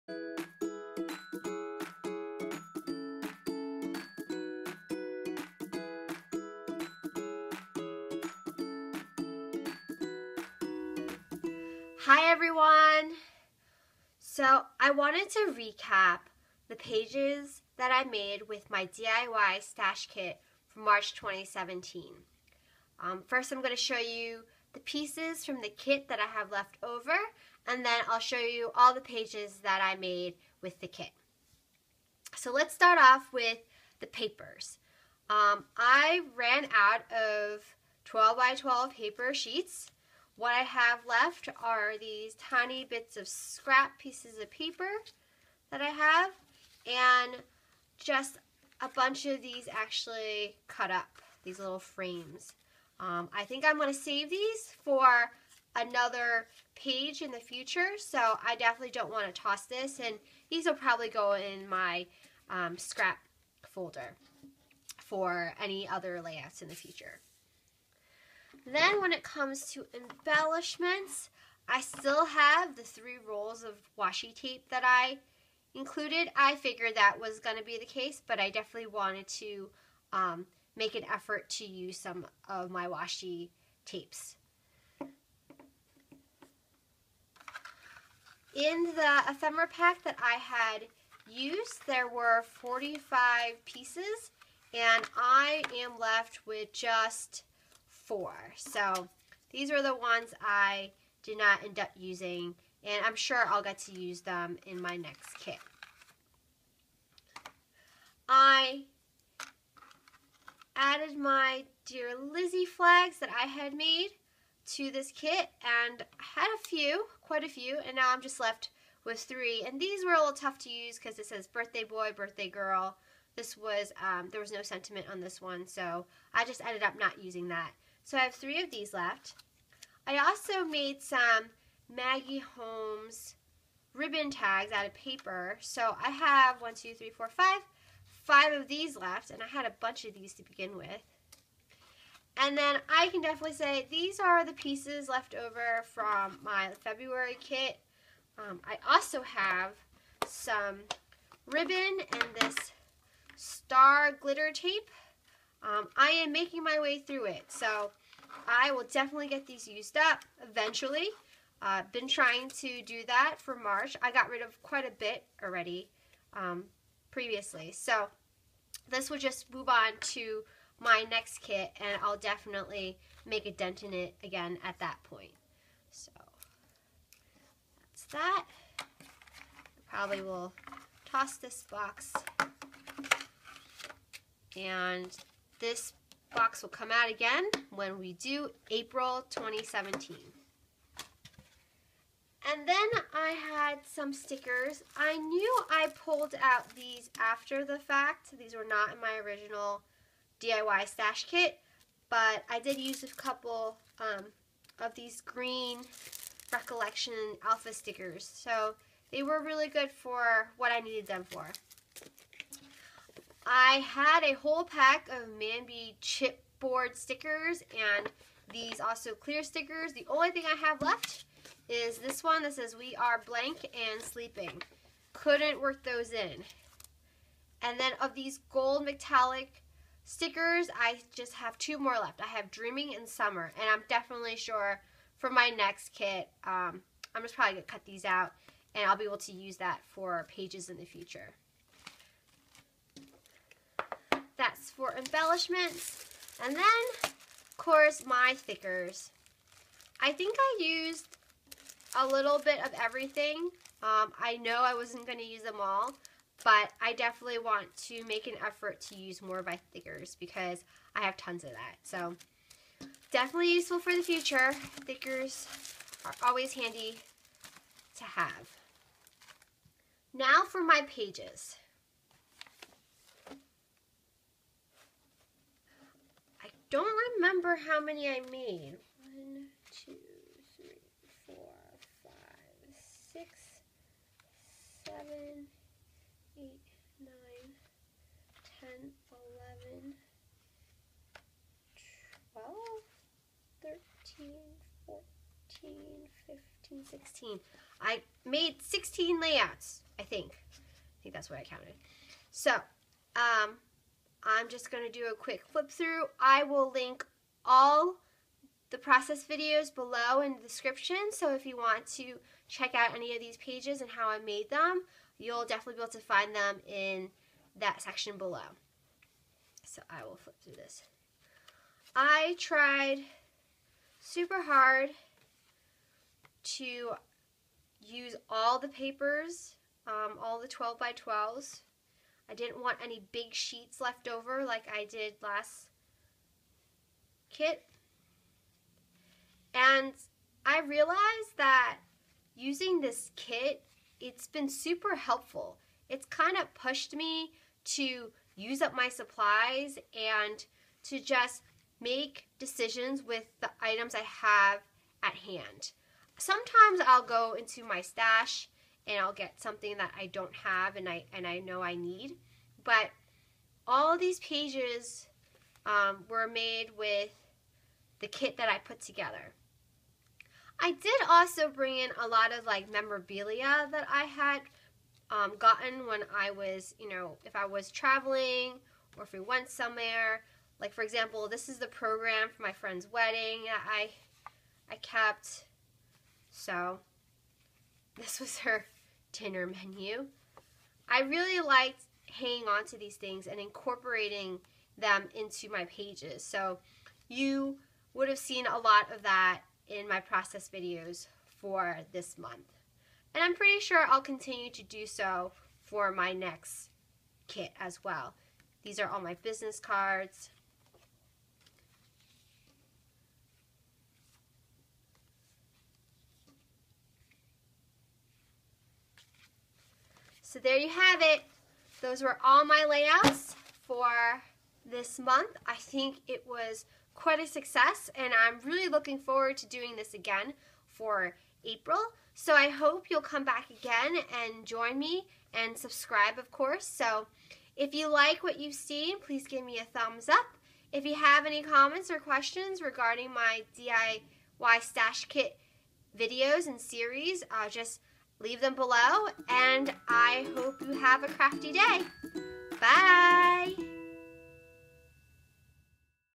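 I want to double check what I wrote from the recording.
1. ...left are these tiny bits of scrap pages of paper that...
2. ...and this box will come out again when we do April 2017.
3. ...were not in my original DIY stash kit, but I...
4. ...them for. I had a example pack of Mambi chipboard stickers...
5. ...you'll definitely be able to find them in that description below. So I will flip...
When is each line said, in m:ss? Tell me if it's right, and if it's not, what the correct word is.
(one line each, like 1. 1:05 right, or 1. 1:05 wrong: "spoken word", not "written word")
1. 0:41 wrong: "pieces", not "pages"
2. 3:04 right
3. 3:18 right
4. 3:31 wrong: "whole", not "example"
5. 5:15 wrong: "section", not "description".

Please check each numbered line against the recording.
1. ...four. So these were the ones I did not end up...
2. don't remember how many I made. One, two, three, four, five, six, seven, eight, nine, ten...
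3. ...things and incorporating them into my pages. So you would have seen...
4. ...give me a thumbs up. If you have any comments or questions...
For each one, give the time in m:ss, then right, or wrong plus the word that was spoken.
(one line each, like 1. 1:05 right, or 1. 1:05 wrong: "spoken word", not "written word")
1. 1:38 right
2. 4:36 right
3. 6:32 right
4. 7:19 right.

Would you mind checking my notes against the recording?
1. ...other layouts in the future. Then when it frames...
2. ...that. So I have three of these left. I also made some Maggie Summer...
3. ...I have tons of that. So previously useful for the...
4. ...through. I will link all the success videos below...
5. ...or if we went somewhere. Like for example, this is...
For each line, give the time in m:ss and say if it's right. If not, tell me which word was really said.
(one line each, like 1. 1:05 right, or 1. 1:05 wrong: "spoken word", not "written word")
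1. 1:05 wrong: "comes", not "frames"
2. 2:07 wrong: "Holmes", not "Summer"
3. 4:20 wrong: "definitely", not "previously"
4. 5:05 wrong: "process", not "success"
5. 6:18 right.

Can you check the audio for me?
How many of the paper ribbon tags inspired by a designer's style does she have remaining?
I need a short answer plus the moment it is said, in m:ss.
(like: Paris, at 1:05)
5, at 2:18.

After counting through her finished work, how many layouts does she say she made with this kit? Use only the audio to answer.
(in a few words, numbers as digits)
16.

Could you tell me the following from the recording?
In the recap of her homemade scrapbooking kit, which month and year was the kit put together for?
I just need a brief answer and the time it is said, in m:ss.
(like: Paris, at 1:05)
March 2017, at 0:20.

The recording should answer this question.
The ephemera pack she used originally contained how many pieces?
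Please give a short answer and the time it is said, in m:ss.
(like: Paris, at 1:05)
45, at 1:32.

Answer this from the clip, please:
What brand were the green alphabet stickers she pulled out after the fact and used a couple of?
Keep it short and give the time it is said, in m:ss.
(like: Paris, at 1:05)
Recollection, at 3:26.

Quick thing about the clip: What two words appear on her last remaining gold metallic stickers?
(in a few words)
Dreaming and Summer.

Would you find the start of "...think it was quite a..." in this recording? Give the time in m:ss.
7:05.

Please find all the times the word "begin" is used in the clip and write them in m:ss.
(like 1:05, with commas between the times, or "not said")
2:20.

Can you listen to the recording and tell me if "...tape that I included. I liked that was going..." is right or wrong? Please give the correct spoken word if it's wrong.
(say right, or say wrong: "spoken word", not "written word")
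wrong: "figured", not "liked".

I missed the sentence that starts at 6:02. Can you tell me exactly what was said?
But all these pages um, were made with the kit that I put together.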